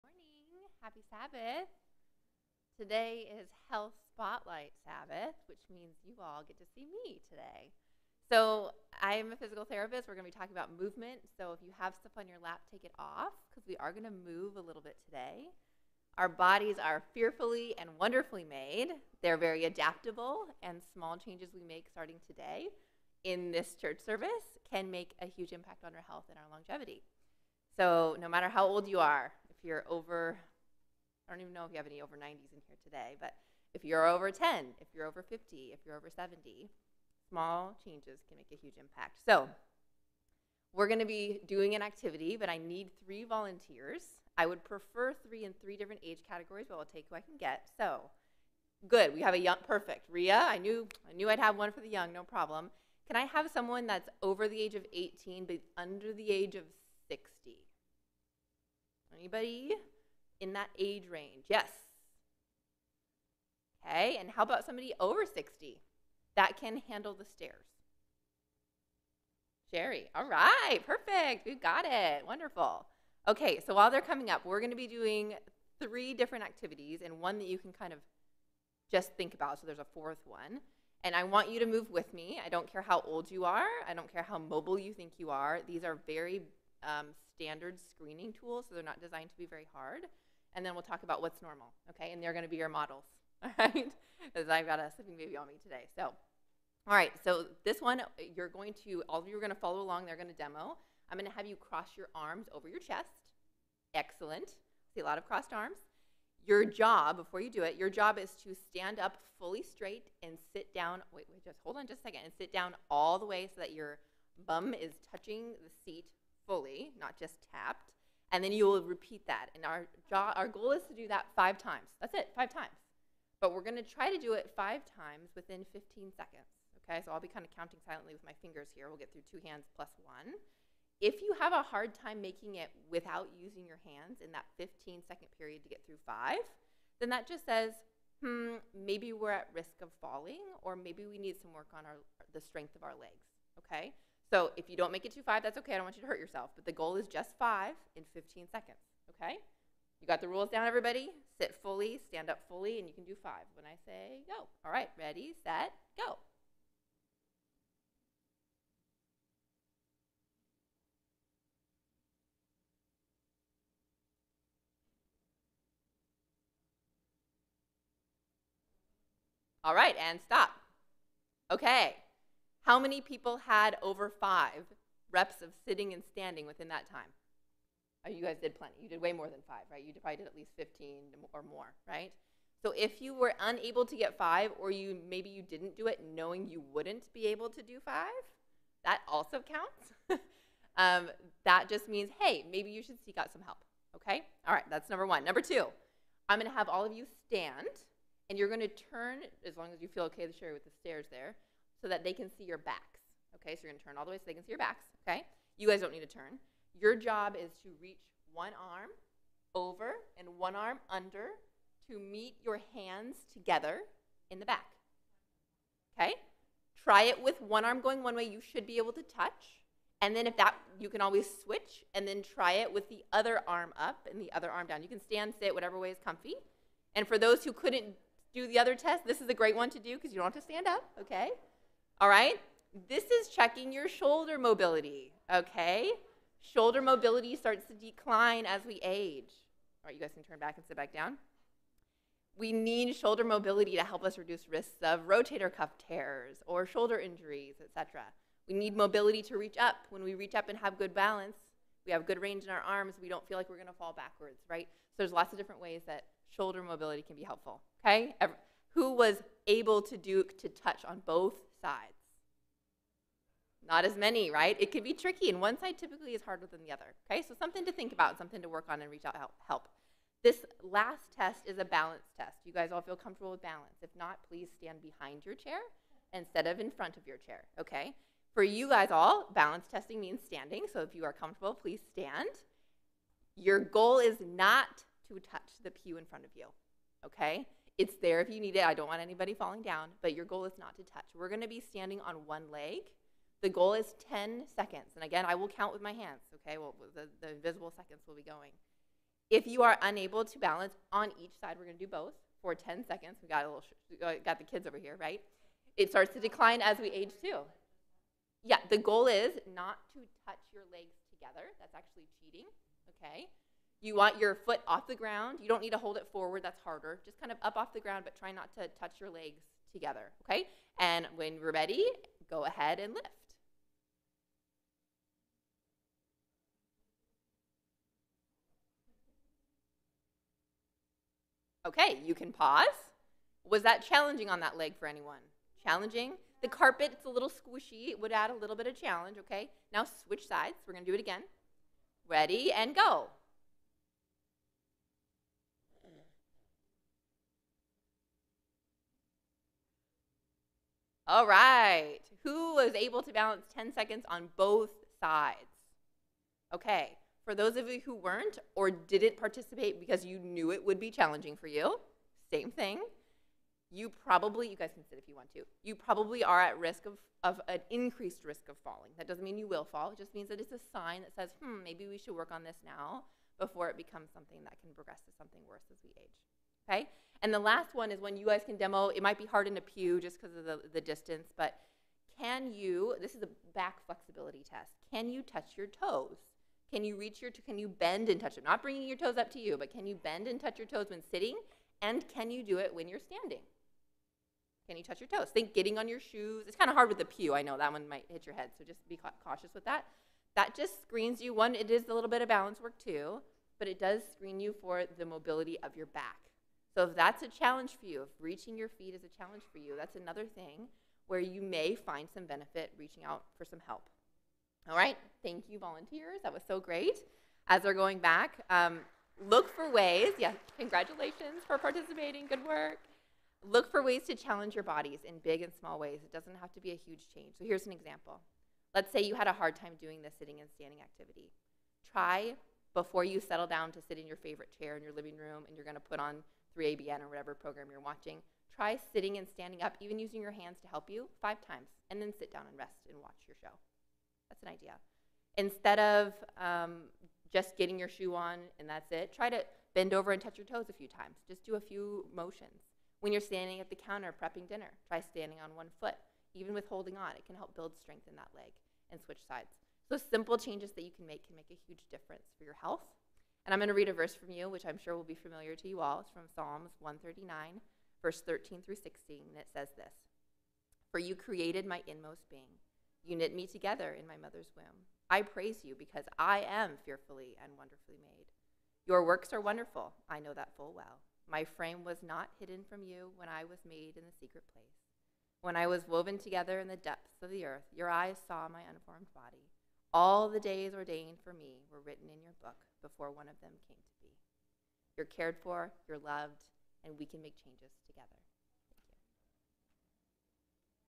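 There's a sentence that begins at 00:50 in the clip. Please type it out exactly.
Ria, I knew, I knew I'd have one for the young, no problem.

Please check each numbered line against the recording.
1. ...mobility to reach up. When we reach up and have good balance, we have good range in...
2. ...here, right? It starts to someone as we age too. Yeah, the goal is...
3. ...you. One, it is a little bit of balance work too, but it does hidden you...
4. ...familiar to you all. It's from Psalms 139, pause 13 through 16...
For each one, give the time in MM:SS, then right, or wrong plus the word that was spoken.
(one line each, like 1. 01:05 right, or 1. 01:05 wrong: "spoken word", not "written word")
1. 04:08 right
2. 05:04 wrong: "decline", not "someone"
3. 06:41 wrong: "screen", not "hidden"
4. 07:45 wrong: "verse", not "pause".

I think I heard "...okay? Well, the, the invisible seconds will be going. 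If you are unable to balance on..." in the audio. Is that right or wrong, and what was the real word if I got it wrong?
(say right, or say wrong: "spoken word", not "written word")
right.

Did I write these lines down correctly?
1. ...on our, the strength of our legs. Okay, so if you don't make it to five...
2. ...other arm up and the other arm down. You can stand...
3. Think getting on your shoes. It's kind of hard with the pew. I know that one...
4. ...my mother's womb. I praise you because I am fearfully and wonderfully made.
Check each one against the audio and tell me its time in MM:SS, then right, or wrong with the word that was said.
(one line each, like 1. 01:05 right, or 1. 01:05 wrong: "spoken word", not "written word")
1. 02:21 right
2. 03:43 right
3. 06:35 right
4. 07:54 right.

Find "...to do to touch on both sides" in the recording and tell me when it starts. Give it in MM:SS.
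04:19.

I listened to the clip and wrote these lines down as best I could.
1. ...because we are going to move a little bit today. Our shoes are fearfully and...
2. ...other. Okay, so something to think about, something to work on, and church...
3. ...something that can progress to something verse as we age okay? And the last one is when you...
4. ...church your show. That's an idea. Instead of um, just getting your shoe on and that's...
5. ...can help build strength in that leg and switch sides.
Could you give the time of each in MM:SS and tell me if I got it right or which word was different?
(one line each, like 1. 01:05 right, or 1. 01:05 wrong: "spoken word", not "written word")
1. 00:13 wrong: "bodies", not "shoes"
2. 04:26 wrong: "reach", not "church"
3. 06:14 wrong: "worse", not "verse"
4. 07:23 wrong: "watch", not "church"
5. 07:37 right.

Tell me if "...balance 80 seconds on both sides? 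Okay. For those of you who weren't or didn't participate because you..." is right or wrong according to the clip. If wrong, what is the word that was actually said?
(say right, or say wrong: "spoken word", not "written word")
wrong: "10", not "80".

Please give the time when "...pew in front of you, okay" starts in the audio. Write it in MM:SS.
04:45.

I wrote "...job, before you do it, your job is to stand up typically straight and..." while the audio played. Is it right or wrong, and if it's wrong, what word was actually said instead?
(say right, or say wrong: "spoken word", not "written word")
wrong: "fully", not "typically".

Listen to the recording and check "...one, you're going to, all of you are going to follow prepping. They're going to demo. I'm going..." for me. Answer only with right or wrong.
wrong.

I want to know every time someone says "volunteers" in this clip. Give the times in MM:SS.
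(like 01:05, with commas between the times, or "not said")
00:43, 06:55.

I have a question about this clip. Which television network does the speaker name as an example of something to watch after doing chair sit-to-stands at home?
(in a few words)
3ABN.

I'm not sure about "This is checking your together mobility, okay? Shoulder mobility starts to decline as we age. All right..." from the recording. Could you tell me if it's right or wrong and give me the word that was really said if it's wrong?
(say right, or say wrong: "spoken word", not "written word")
wrong: "shoulder", not "together".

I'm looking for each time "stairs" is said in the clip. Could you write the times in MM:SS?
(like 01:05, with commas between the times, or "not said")
01:07, 03:20.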